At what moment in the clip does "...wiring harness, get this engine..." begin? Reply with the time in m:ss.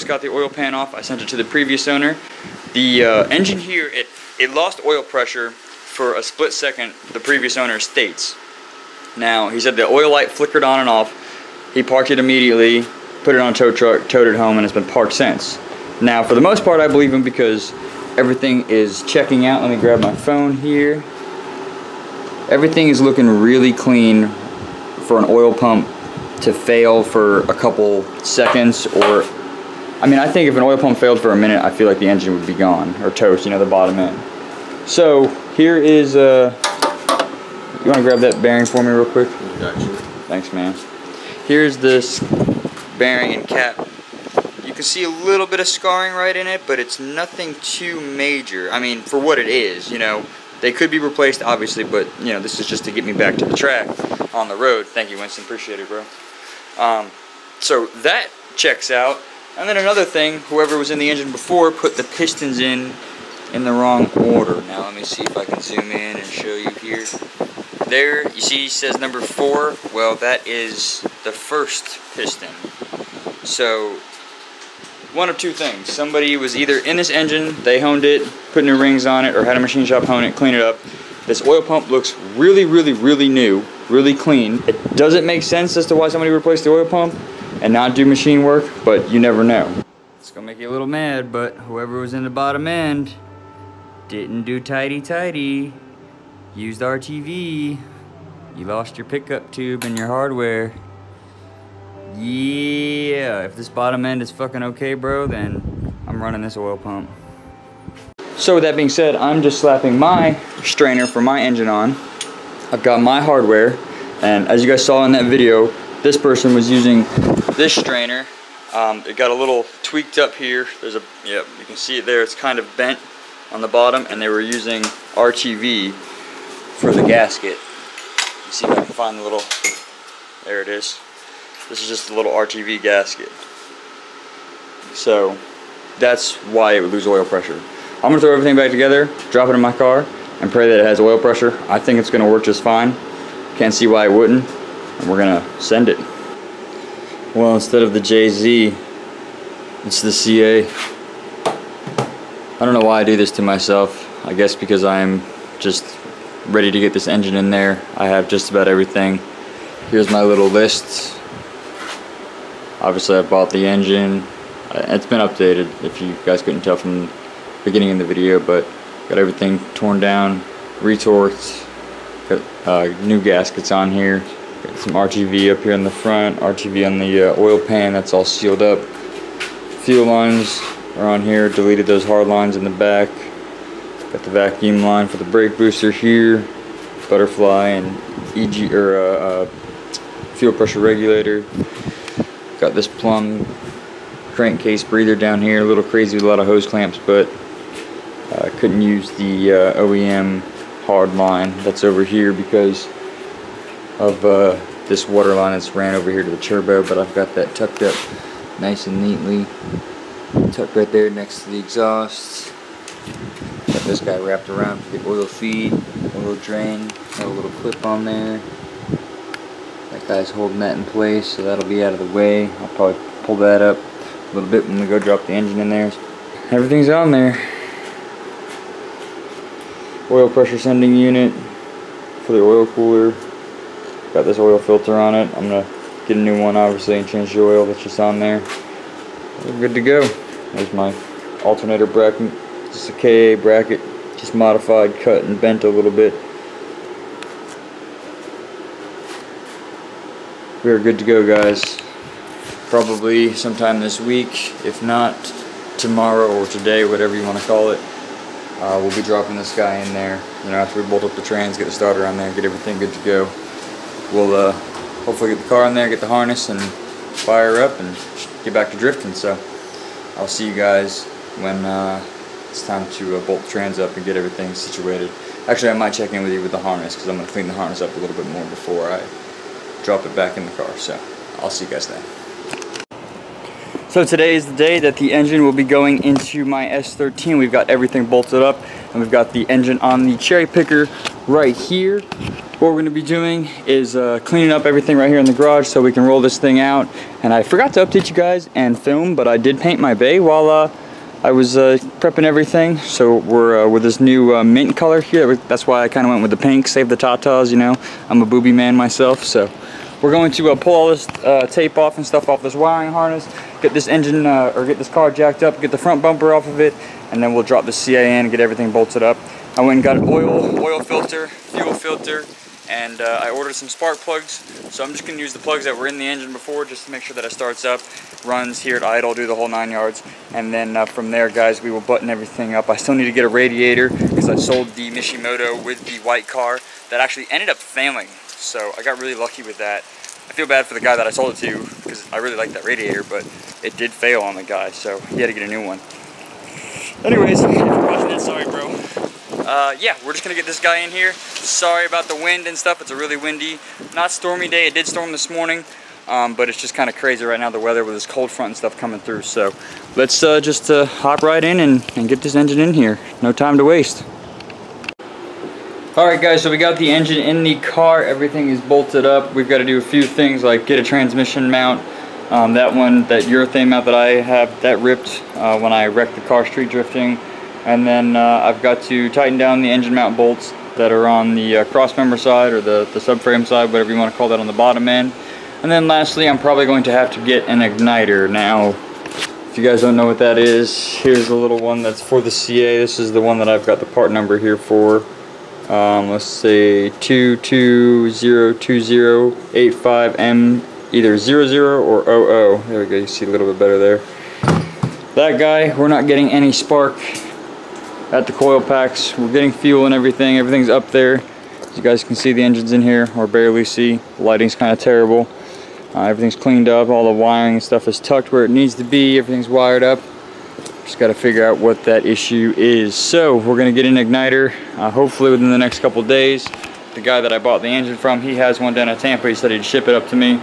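5:12.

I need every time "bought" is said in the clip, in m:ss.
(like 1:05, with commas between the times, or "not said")
2:43, 7:07.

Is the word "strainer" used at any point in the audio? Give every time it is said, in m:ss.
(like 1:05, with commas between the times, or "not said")
1:50, 1:57.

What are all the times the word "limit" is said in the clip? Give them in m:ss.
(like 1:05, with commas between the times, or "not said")
not said.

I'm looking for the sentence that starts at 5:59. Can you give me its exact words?
So let's uh, just uh, hop right in and, and get this engine in here.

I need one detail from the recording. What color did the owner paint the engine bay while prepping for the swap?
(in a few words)
Mint.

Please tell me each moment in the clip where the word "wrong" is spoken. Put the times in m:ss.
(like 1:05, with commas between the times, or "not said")
1:03.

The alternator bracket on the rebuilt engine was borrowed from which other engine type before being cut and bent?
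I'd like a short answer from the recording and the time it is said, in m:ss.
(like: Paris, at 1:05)
KA, at 4:03.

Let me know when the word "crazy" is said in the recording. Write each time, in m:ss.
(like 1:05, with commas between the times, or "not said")
3:15, 5:56.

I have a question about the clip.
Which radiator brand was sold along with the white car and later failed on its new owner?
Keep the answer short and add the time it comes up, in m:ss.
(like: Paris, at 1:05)
Mishimoto, at 5:34.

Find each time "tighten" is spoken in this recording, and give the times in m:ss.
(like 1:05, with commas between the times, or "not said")
6:19.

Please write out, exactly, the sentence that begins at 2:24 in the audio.
And we're going to send it.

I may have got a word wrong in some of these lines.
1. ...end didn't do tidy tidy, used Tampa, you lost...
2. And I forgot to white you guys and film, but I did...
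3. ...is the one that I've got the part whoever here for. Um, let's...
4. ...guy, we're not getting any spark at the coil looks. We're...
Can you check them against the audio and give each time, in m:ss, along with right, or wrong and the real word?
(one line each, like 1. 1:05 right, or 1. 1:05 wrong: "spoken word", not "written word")
1. 1:32 wrong: "RTV", not "Tampa"
2. 4:57 wrong: "update", not "white"
3. 6:32 wrong: "number", not "whoever"
4. 6:45 wrong: "packs", not "looks".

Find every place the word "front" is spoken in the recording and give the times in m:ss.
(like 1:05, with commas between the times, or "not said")
2:55, 5:15, 5:58.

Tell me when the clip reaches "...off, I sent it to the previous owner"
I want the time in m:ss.
0:00.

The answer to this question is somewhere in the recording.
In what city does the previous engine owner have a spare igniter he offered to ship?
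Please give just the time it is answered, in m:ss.
7:09.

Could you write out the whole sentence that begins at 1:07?
There, you see says number four.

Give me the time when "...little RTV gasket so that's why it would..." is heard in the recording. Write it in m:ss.
2:12.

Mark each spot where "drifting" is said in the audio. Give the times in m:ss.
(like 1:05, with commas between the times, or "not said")
4:28, 6:16.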